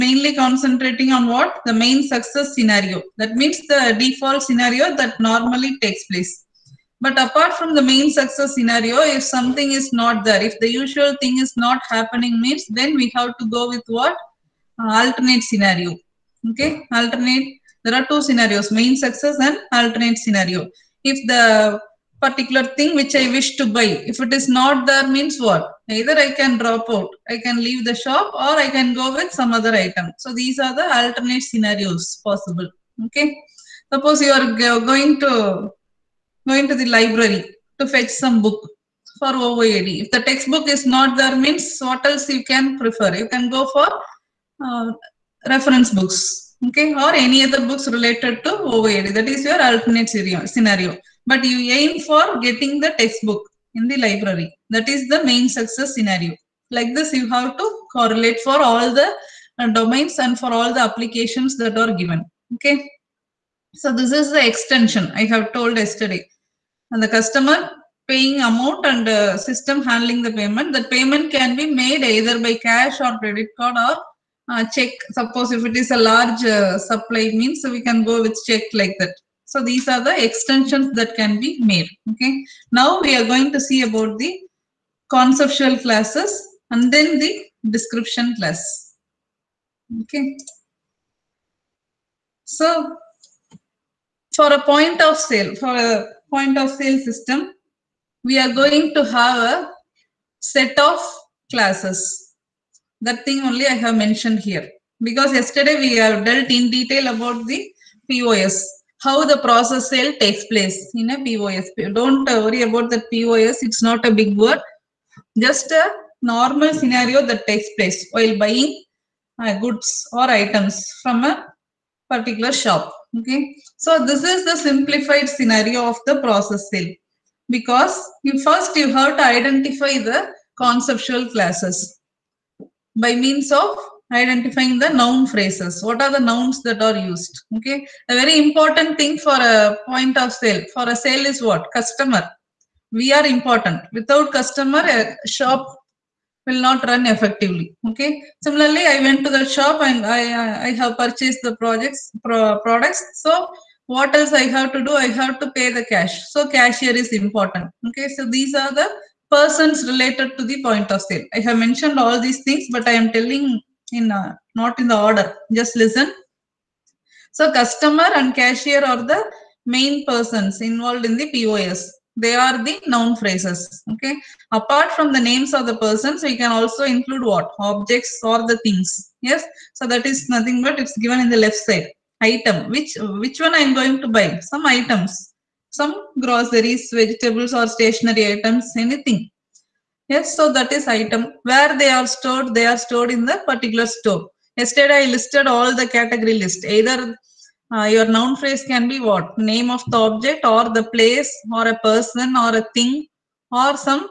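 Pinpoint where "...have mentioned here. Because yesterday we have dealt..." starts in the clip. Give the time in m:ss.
1:43.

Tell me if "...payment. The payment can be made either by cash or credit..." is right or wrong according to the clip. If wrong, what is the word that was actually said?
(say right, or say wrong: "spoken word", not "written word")
right.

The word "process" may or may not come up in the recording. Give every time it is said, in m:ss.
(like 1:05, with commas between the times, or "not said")
1:49, 2:06.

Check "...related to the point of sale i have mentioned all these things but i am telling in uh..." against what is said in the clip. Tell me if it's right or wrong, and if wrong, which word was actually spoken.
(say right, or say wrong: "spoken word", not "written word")
right.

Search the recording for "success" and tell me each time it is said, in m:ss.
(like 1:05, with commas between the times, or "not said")
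0:02, 0:08, 0:18, 0:55.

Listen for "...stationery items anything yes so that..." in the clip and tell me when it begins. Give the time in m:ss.
3:07.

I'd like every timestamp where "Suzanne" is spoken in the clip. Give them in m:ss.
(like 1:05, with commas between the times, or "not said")
not said.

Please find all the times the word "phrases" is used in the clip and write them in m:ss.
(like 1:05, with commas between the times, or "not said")
2:15, 2:53, 3:18.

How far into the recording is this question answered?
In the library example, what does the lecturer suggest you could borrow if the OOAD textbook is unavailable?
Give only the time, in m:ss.
0:45.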